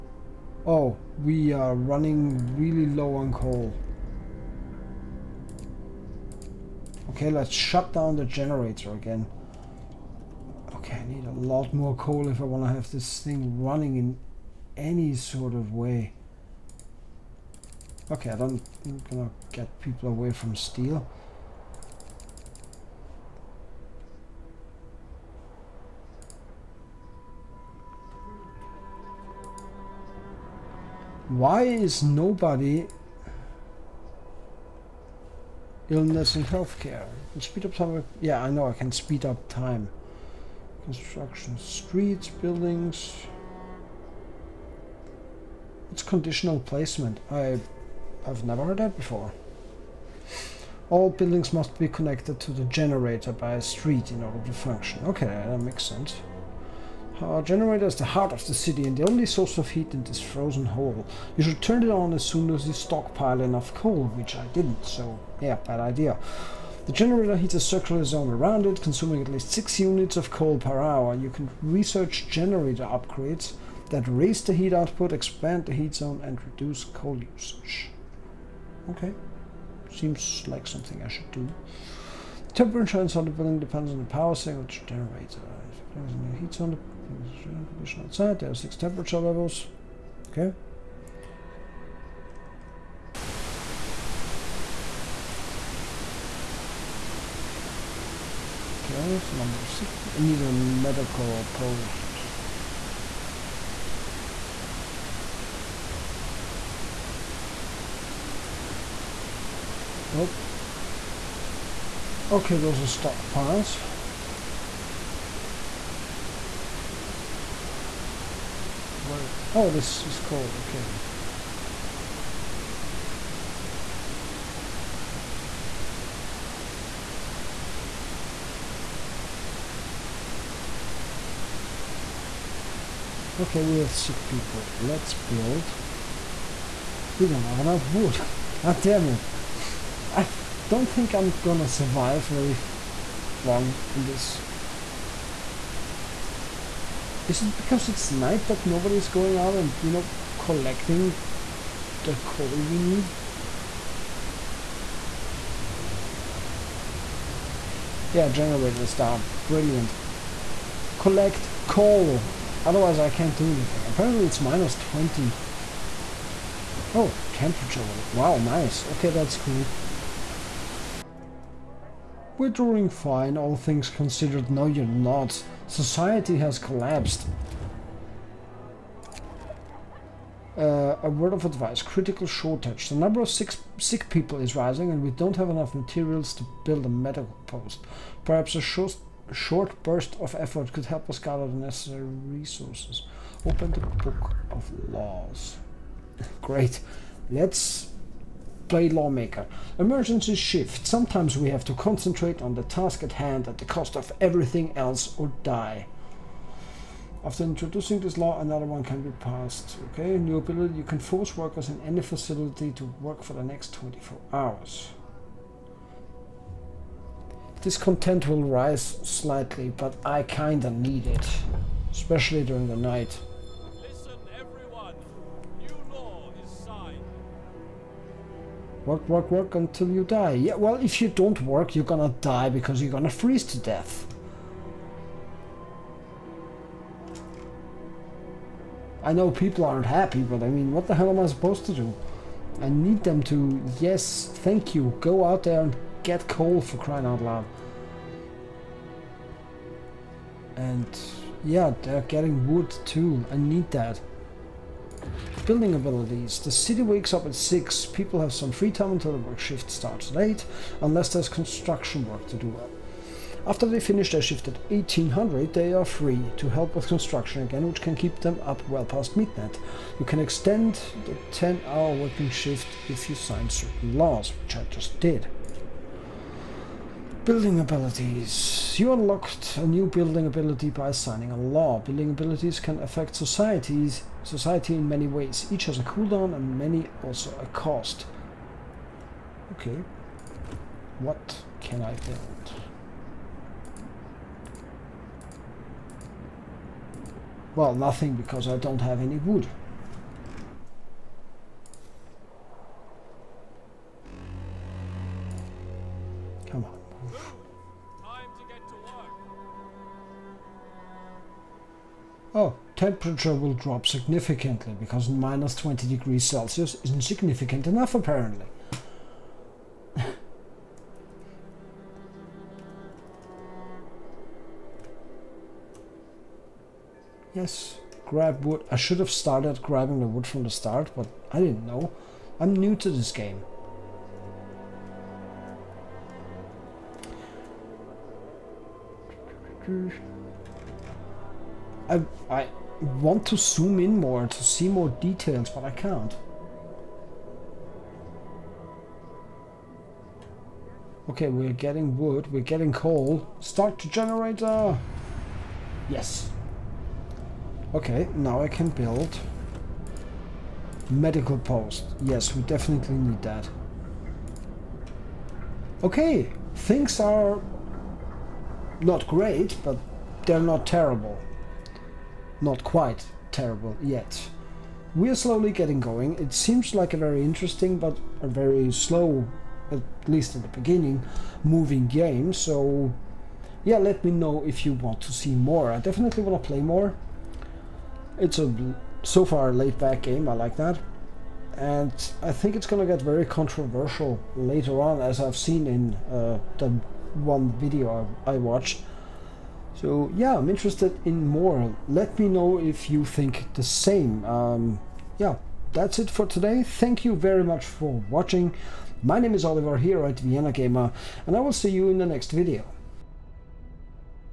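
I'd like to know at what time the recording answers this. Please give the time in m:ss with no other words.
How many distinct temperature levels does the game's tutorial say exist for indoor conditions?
1:28.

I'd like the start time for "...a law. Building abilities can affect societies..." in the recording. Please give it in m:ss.
4:41.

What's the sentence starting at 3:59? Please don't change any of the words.
I know people aren't happy, but I mean, what the hell am I supposed to do?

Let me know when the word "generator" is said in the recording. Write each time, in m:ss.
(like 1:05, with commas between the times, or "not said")
0:08, 0:52, 0:57, 1:06, 1:12, 1:24, 2:38, 5:53.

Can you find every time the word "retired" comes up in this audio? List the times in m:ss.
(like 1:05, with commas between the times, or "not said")
not said.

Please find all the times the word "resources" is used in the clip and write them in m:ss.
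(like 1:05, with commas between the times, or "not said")
3:12.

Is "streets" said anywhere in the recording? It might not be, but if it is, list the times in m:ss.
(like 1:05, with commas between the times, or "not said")
0:41, 0:53.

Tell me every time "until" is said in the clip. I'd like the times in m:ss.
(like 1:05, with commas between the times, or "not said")
3:49, 4:18.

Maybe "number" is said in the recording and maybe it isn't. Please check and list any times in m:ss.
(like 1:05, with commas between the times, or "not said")
1:39, 3:02.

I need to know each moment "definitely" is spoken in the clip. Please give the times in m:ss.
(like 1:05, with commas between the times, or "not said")
6:02, 6:25.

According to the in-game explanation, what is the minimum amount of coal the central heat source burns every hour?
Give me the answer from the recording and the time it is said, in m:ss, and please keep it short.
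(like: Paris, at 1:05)
6 units, at 1:09.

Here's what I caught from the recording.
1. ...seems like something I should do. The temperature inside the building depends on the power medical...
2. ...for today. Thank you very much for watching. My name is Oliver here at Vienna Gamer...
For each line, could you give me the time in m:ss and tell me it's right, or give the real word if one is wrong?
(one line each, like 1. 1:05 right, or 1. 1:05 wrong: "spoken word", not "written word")
1. 1:19 wrong: "signal", not "medical"
2. 6:46 right.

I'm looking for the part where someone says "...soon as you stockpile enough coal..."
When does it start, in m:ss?
1:02.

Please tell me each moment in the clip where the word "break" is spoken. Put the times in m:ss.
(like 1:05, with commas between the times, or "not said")
not said.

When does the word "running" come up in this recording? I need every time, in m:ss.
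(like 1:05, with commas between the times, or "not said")
0:01, 0:13.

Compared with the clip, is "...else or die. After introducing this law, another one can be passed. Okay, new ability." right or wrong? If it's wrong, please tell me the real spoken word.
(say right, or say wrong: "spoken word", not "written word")
right.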